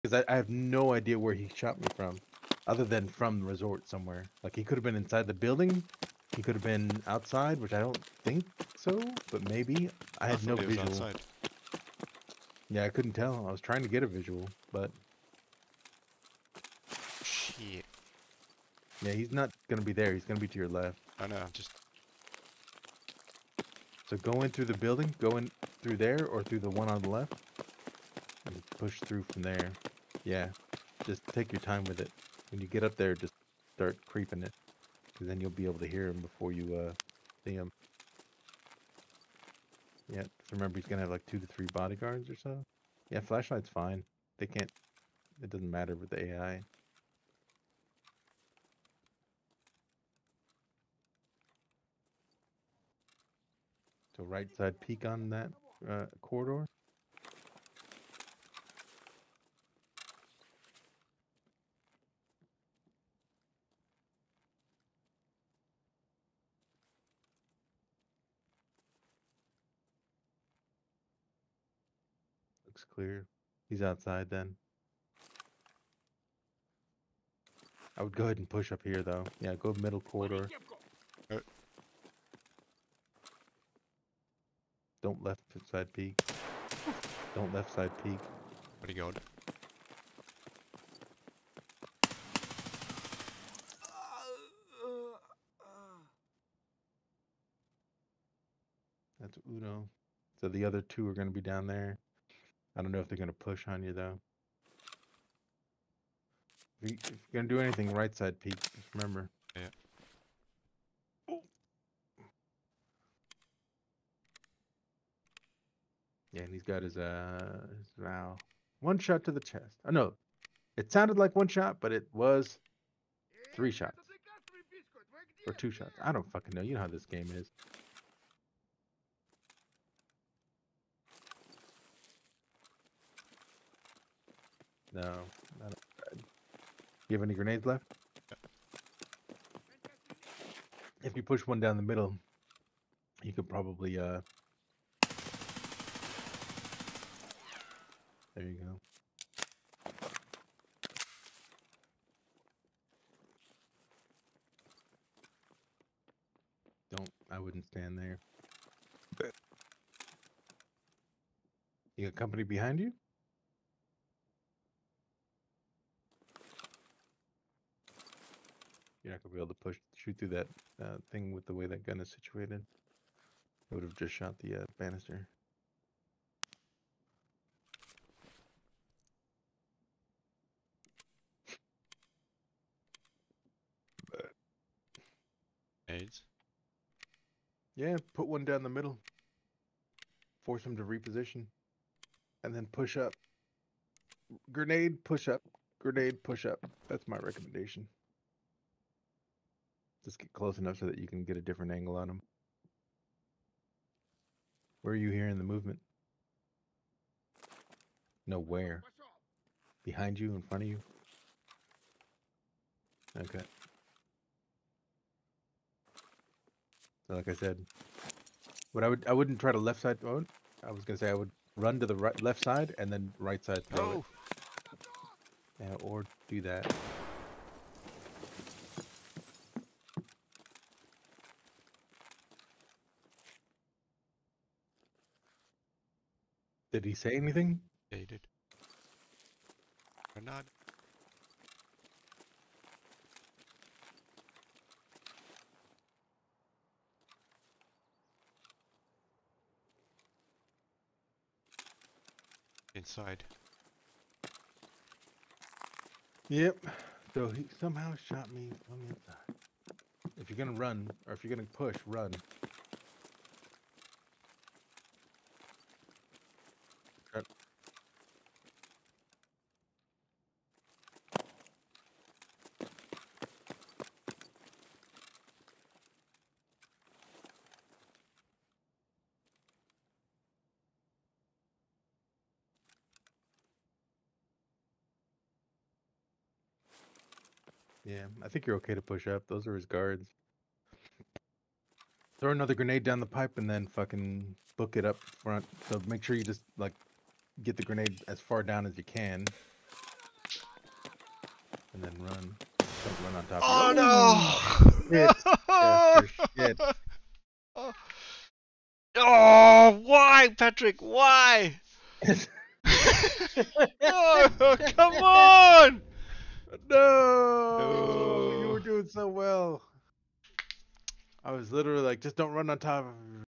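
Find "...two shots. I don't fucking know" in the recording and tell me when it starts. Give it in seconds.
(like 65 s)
125 s.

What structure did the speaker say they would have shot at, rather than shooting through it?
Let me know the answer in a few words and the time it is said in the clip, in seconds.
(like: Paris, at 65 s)
banister, at 174 s.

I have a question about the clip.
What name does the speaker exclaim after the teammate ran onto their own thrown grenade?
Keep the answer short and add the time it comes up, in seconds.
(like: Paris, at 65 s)
Patrick, at 310 s.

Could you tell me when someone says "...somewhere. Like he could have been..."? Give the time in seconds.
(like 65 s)
3 s.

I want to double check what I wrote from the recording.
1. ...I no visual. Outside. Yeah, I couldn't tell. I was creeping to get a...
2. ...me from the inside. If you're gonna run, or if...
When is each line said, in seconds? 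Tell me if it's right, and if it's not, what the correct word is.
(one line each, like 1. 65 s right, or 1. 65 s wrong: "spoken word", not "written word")
1. 10 s wrong: "trying", not "creeping"
2. 258 s right.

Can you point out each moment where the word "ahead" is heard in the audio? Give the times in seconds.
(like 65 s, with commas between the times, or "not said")
78 s.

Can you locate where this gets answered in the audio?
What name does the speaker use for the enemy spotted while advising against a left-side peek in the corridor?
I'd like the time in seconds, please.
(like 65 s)
99 s.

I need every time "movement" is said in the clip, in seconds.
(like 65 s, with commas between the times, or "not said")
205 s.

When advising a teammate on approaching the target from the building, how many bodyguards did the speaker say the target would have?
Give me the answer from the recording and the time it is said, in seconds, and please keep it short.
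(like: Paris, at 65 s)
2 to 3, at 41 s.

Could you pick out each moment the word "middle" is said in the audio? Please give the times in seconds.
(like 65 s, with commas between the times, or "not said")
79 s, 141 s, 188 s.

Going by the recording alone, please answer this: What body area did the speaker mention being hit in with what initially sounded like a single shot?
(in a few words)
chest.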